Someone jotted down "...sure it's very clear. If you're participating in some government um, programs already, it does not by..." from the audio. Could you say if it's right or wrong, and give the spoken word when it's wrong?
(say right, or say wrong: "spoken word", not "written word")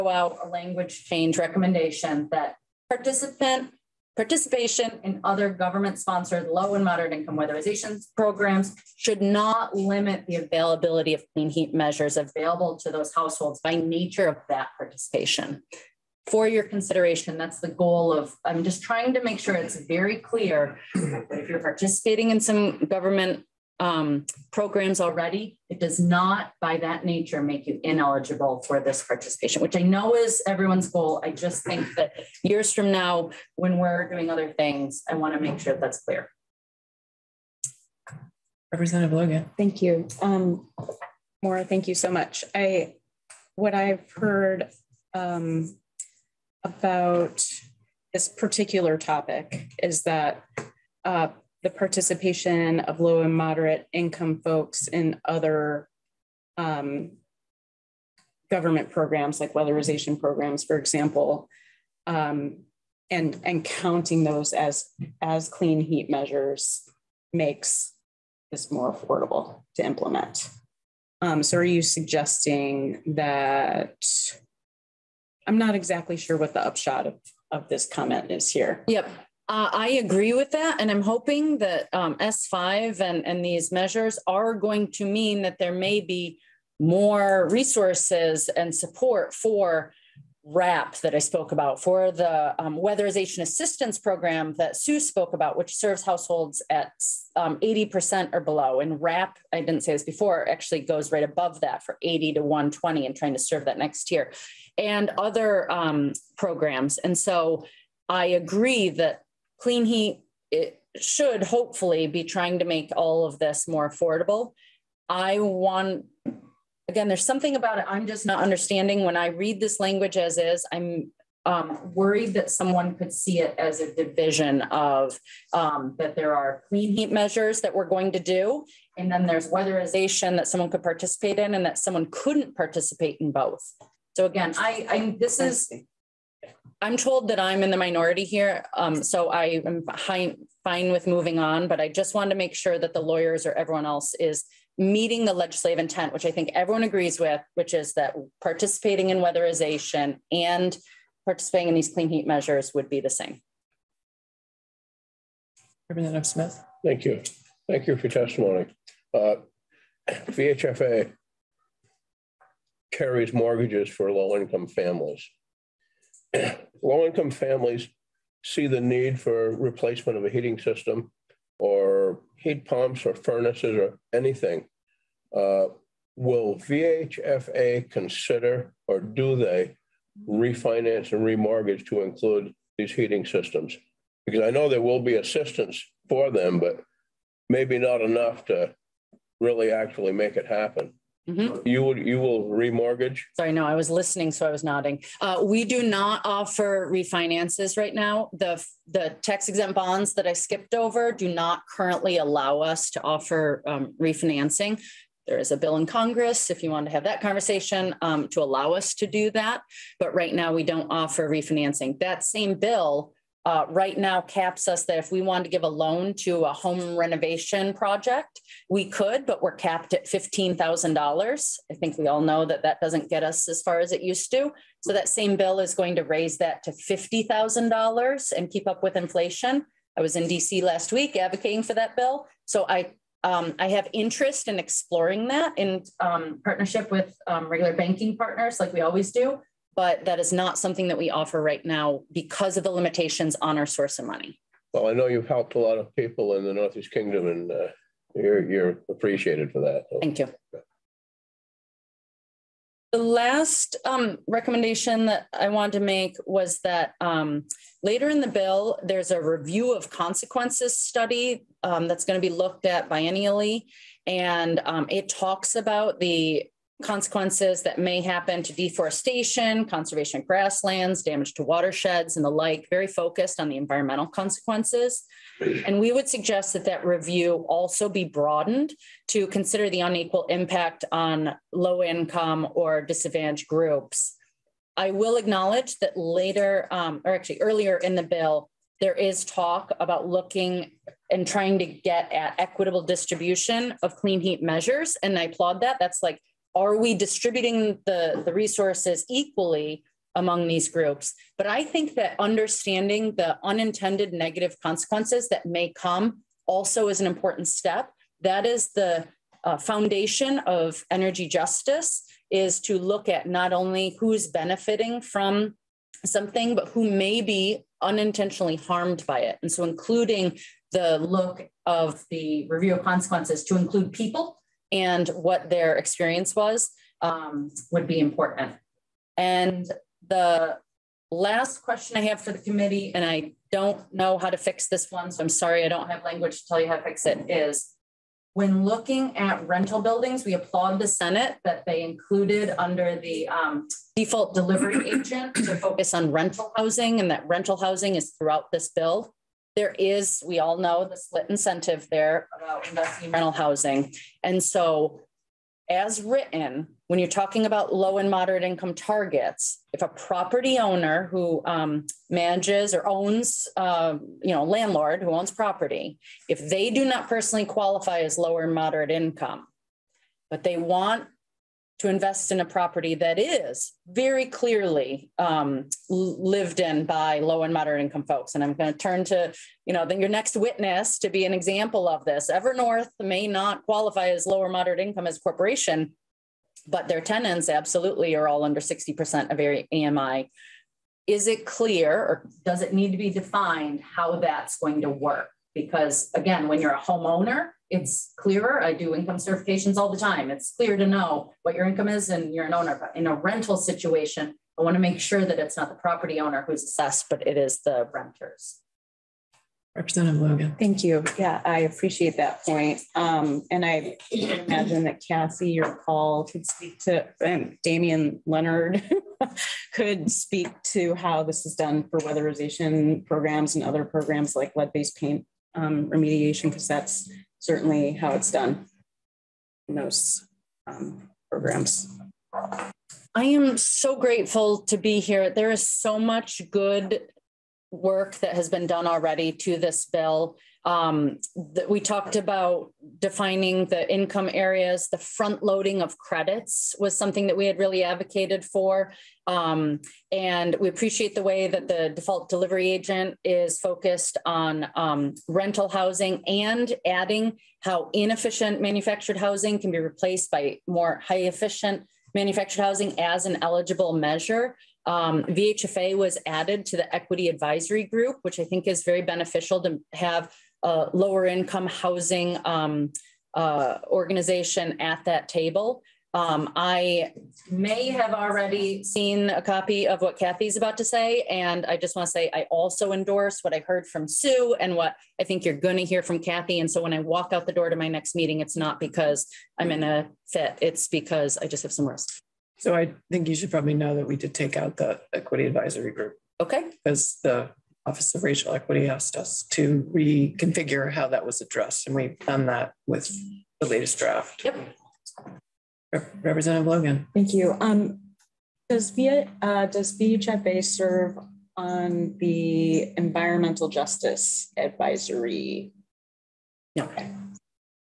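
right.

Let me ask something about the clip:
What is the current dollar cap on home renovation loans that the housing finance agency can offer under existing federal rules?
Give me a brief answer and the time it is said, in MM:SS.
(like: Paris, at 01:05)
$15,000, at 03:40.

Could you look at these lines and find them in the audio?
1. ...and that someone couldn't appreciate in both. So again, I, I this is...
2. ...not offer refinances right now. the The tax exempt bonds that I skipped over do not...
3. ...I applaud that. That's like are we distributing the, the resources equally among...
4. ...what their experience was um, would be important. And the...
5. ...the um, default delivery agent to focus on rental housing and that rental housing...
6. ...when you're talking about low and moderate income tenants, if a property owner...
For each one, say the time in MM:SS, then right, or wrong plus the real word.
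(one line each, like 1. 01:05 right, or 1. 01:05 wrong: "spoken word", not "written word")
1. 02:11 wrong: "participate", not "appreciate"
2. 03:15 right
3. 04:55 right
4. 05:25 right
5. 05:42 right
6. 05:56 wrong: "targets", not "tenants".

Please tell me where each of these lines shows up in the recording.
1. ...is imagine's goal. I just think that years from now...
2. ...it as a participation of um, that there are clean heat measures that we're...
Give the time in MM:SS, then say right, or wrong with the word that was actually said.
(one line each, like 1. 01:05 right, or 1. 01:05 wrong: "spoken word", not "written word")
1. 00:30 wrong: "everyone", not "imagine"
2. 02:03 wrong: "division", not "participation".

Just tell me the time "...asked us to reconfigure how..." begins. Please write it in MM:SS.
08:18.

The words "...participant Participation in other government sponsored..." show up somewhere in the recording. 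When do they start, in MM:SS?
00:02.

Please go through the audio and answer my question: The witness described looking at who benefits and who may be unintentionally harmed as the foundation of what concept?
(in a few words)
Energy justice.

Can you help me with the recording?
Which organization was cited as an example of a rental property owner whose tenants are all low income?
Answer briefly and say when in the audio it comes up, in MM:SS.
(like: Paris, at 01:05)
Evernorth, at 06:22.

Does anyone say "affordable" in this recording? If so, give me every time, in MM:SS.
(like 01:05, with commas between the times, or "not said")
01:08, 01:53.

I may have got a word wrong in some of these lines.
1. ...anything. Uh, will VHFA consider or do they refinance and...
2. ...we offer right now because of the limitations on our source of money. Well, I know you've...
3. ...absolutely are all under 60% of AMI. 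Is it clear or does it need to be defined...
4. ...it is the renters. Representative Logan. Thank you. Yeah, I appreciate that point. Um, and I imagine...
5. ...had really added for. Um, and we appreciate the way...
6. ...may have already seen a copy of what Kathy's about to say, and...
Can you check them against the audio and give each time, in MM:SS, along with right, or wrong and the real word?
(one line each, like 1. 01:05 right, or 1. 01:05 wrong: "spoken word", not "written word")
1. 02:54 right
2. 04:00 right
3. 06:27 right
4. 06:47 right
5. 07:27 wrong: "advocated", not "added"
6. 07:57 right.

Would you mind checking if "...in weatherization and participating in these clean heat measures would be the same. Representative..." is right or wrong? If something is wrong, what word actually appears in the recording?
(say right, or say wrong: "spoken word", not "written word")
right.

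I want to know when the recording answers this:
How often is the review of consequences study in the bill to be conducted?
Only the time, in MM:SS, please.
04:22.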